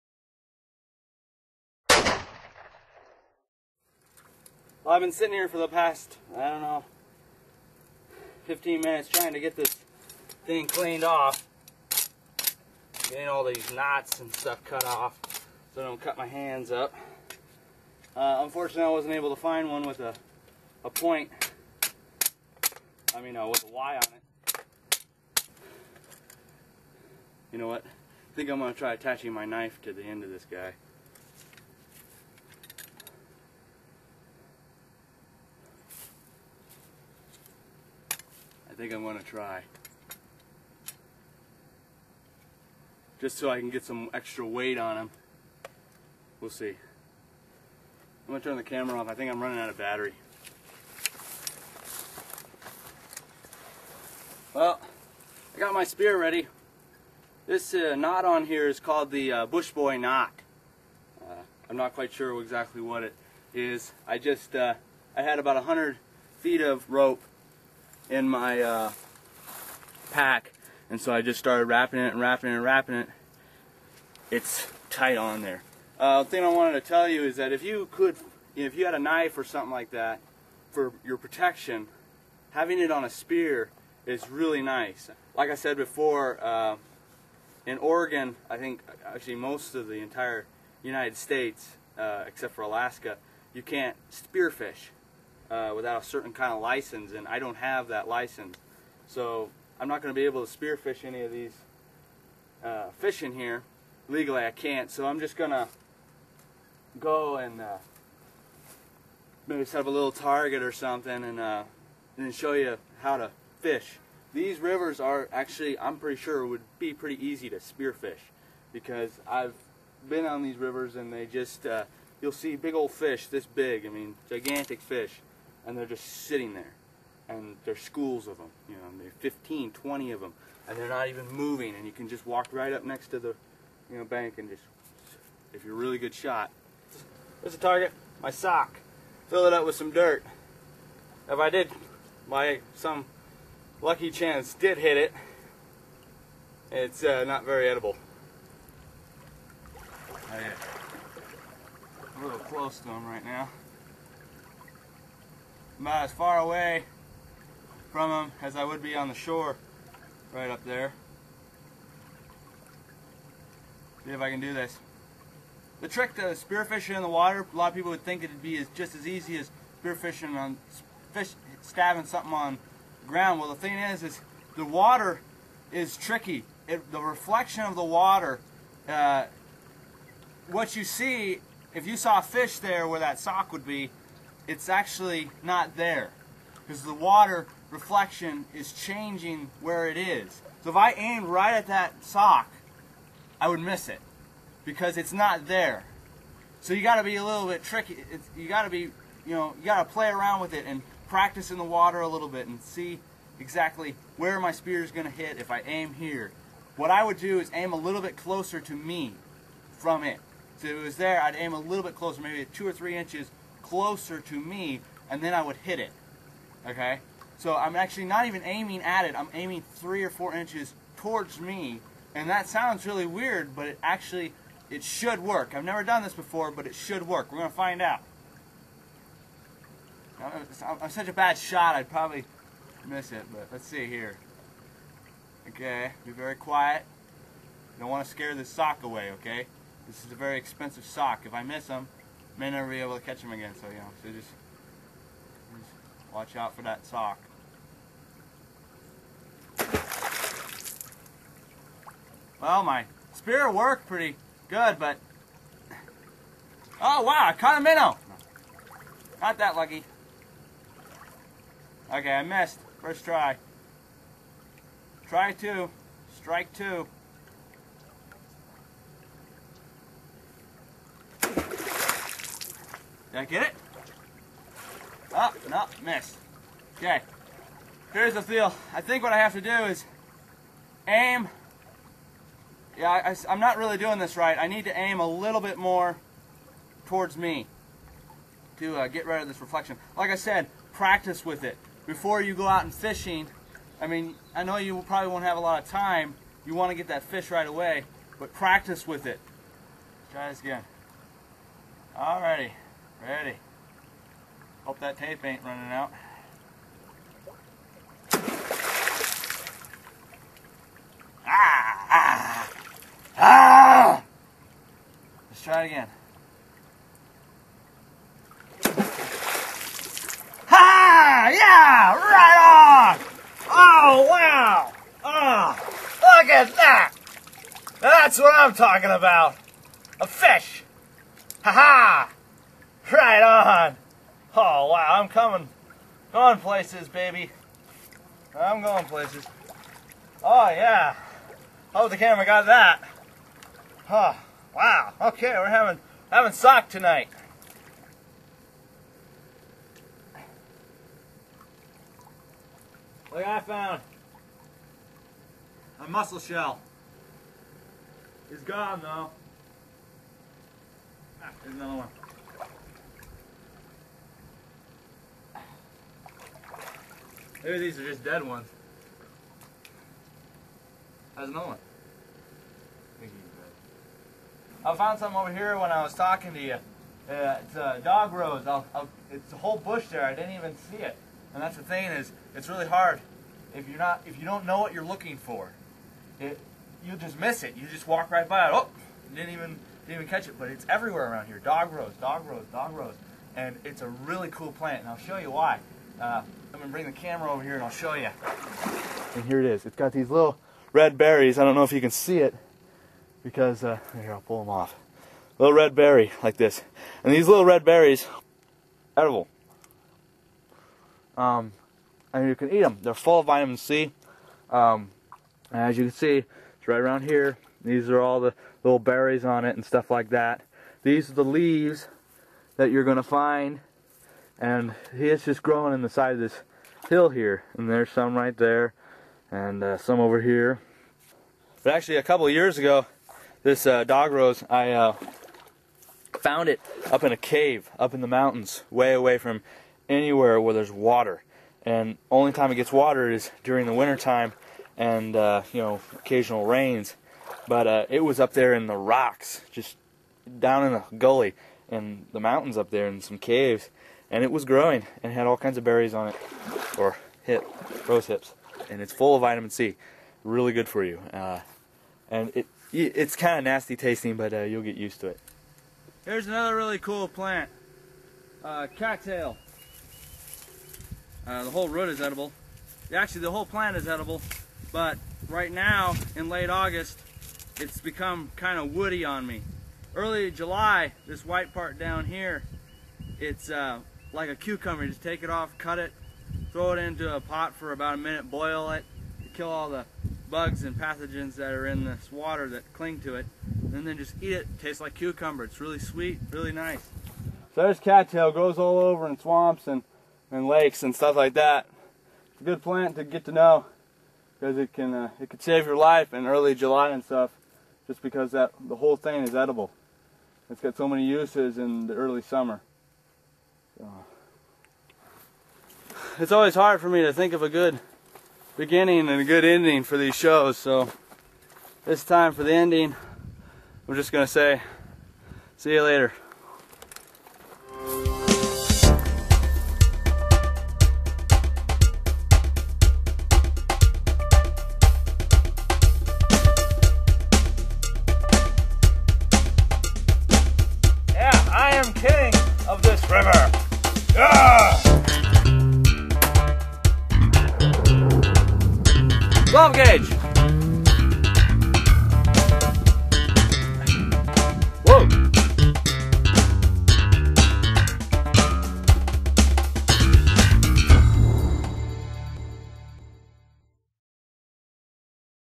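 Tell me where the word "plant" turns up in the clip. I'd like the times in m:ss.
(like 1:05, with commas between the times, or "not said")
6:34, 7:47, 7:53, 8:22.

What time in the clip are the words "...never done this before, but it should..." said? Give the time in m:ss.
3:45.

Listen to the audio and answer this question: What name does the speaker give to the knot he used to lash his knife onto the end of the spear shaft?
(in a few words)
Bush Boy knot.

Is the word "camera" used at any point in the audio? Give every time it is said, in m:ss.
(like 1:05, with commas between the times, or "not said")
0:48, 5:41, 6:36.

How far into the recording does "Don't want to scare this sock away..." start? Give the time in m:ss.
3:57.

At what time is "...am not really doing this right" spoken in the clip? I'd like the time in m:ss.
4:43.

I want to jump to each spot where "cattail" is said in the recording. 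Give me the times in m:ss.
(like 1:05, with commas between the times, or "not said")
7:48, 8:17.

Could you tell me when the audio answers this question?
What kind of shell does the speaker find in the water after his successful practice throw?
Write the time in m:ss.
5:55.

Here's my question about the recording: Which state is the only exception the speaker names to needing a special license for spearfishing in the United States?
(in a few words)
Alaska.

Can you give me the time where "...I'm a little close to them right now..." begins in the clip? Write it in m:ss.
2:32.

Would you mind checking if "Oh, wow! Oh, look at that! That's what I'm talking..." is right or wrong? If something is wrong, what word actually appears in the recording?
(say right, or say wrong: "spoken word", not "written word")
right.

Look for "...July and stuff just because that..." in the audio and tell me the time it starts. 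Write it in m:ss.
8:26.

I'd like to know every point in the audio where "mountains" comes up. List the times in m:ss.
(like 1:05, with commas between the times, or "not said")
7:18, 7:32.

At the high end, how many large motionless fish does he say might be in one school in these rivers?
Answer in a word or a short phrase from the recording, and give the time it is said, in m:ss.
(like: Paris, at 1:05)
20, at 2:09.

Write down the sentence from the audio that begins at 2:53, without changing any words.
Well, the thing is, is the water is tricky.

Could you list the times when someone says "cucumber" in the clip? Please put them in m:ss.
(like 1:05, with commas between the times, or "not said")
8:04, 8:14.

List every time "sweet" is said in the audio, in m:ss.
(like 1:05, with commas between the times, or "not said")
8:15.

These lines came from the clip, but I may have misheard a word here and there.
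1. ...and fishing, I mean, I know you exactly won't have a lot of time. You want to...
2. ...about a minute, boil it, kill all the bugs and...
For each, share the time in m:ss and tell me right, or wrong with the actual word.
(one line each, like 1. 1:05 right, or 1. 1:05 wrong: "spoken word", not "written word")
1. 4:52 wrong: "probably", not "exactly"
2. 8:07 right.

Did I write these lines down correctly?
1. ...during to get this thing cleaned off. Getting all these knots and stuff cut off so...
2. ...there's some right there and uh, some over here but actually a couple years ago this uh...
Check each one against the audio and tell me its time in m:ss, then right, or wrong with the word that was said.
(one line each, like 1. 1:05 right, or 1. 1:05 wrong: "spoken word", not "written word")
1. 0:09 wrong: "trying", not "during"
2. 7:07 right.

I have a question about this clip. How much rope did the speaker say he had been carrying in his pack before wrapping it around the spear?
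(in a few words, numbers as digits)
100 feet.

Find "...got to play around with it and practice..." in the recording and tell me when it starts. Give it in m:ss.
3:19.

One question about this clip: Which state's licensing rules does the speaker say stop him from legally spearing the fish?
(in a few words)
Oregon.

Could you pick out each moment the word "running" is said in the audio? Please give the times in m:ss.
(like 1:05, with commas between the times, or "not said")
0:49, 5:05.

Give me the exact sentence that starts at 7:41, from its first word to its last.
Uh, and it it's kind of nasty tasting, but uh, you'll get used to it.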